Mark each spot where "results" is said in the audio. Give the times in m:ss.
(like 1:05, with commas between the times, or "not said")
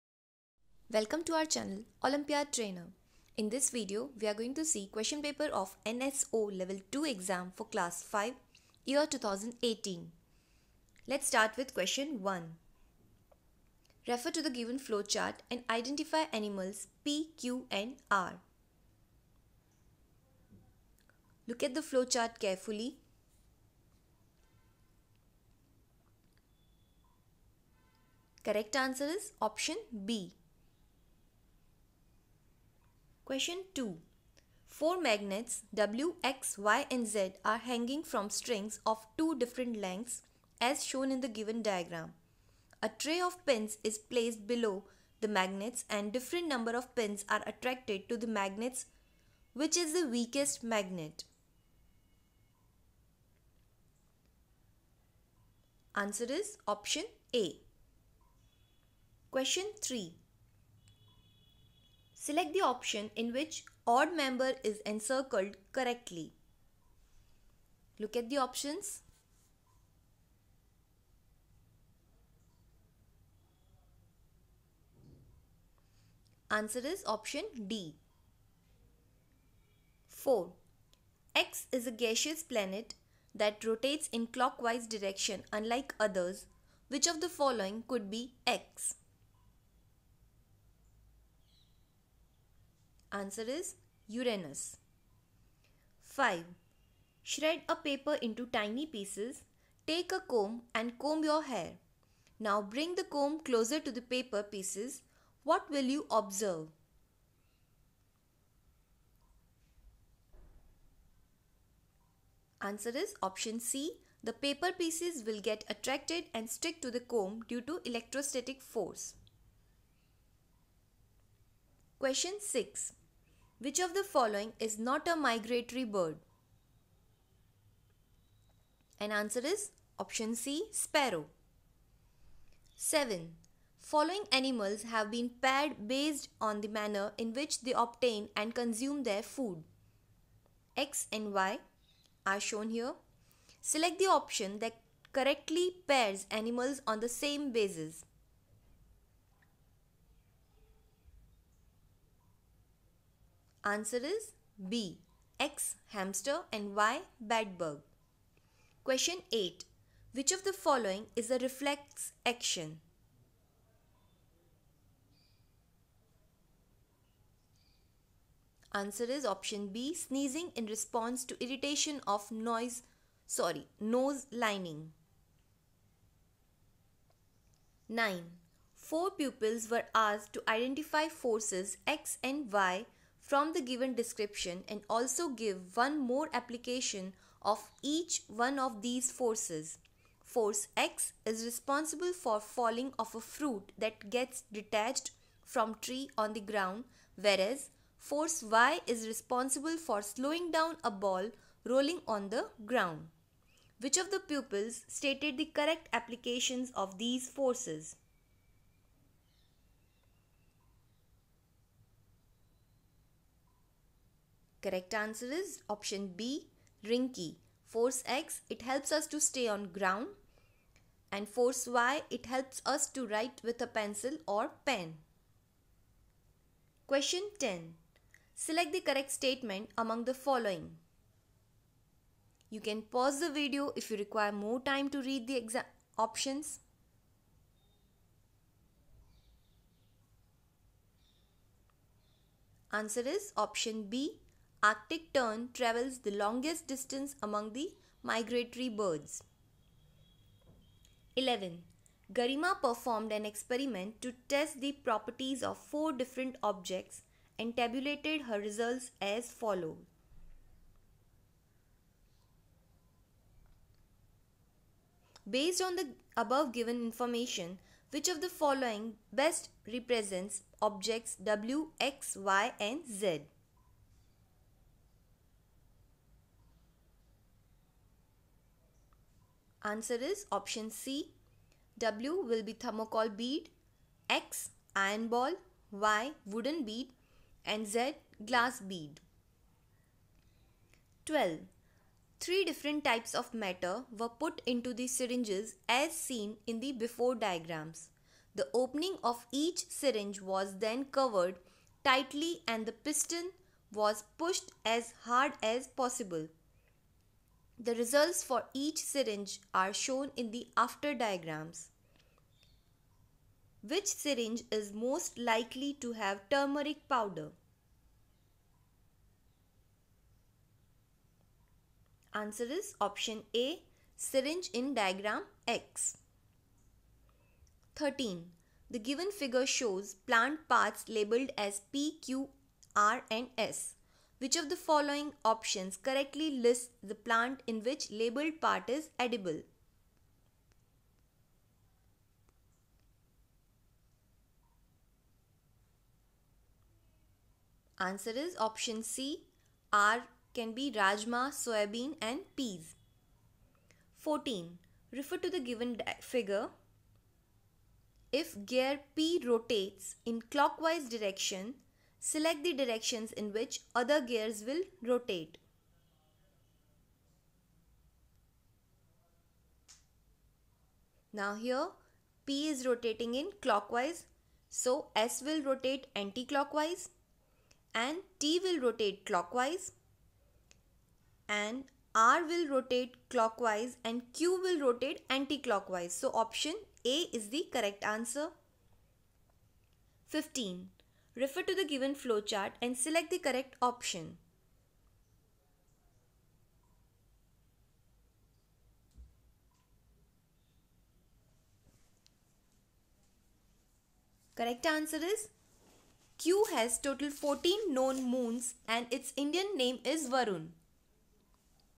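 4:18, 5:07.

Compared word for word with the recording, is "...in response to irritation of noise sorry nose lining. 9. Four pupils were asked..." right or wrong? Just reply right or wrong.
right.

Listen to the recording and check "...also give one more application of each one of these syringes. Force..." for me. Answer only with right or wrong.
wrong.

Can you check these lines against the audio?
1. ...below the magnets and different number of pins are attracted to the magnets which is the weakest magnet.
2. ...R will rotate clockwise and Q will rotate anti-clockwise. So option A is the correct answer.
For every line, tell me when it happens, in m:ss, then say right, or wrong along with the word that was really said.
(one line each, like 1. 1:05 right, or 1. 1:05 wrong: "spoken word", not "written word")
1. 0:44 right
2. 6:21 right.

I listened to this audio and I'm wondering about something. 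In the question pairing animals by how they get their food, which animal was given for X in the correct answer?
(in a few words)
Hamster.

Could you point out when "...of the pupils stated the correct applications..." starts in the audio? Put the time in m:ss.
3:23.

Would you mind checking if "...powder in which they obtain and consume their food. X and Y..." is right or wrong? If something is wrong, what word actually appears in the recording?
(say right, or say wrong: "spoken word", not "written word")
wrong: "manner", not "powder".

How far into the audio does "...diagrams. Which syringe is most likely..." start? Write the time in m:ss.
5:10.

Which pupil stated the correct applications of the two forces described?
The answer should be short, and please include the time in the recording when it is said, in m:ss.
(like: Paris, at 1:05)
Rinky, at 3:36.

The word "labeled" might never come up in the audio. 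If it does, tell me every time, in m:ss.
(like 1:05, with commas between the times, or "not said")
5:30, 5:37.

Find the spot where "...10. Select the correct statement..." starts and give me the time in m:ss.
3:47.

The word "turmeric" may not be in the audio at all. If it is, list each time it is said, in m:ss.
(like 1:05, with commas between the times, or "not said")
5:16.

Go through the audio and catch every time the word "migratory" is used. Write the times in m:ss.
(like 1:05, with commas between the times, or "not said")
2:05, 4:08.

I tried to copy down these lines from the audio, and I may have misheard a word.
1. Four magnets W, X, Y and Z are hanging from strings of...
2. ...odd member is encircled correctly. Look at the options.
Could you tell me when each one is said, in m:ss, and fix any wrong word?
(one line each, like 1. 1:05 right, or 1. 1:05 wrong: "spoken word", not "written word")
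1. 0:34 right
2. 1:03 right.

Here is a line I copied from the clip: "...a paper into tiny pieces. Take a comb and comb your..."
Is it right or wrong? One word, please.
right.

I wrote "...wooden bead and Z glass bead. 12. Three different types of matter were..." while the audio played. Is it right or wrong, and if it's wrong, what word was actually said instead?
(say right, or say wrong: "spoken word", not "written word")
right.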